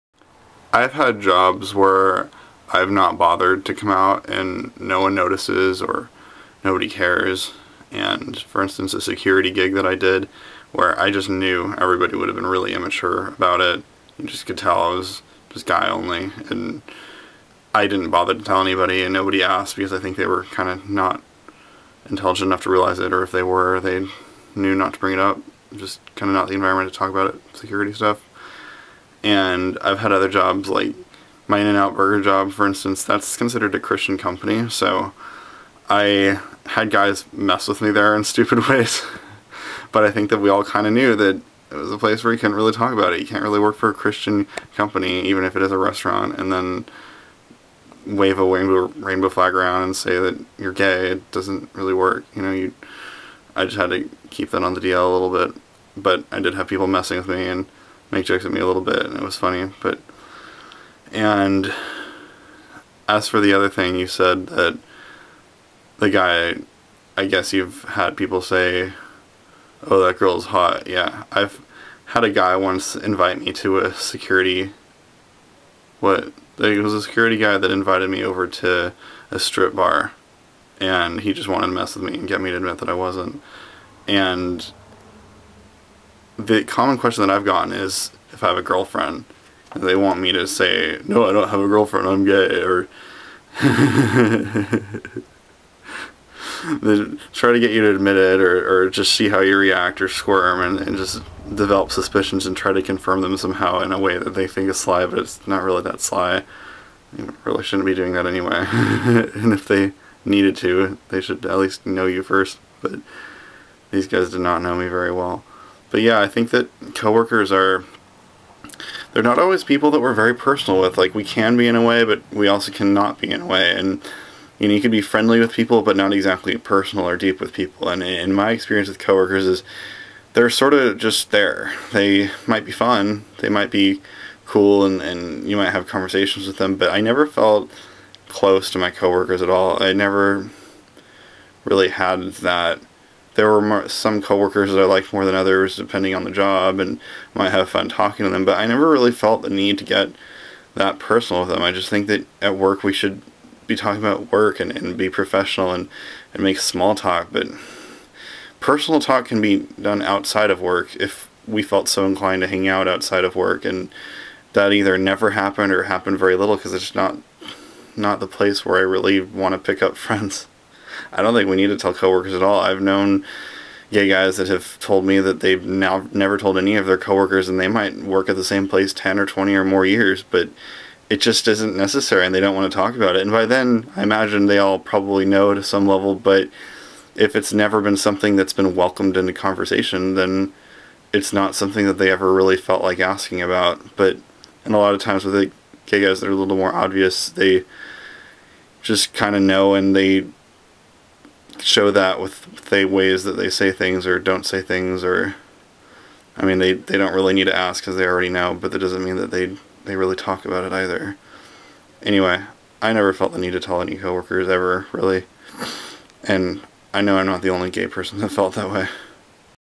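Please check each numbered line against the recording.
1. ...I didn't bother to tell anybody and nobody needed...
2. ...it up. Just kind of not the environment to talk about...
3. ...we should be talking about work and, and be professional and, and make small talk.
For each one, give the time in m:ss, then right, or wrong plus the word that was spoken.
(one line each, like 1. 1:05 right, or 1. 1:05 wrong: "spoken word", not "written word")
1. 0:17 wrong: "asked", not "needed"
2. 0:25 right
3. 2:32 right.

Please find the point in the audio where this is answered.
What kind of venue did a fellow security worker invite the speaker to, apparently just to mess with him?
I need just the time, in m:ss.
1:19.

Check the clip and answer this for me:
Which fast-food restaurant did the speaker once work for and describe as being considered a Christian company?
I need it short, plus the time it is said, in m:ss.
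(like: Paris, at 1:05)
In-N-Out Burger, at 0:31.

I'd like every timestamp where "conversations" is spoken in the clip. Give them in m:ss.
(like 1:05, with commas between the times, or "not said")
2:15, 3:09.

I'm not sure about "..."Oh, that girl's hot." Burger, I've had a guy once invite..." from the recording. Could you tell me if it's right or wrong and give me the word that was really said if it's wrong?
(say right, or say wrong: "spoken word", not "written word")
wrong: "Yeah", not "Burger".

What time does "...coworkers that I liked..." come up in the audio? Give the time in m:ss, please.
2:24.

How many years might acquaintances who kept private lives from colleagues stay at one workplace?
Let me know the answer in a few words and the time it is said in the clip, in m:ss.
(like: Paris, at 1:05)
10 or 20, at 2:58.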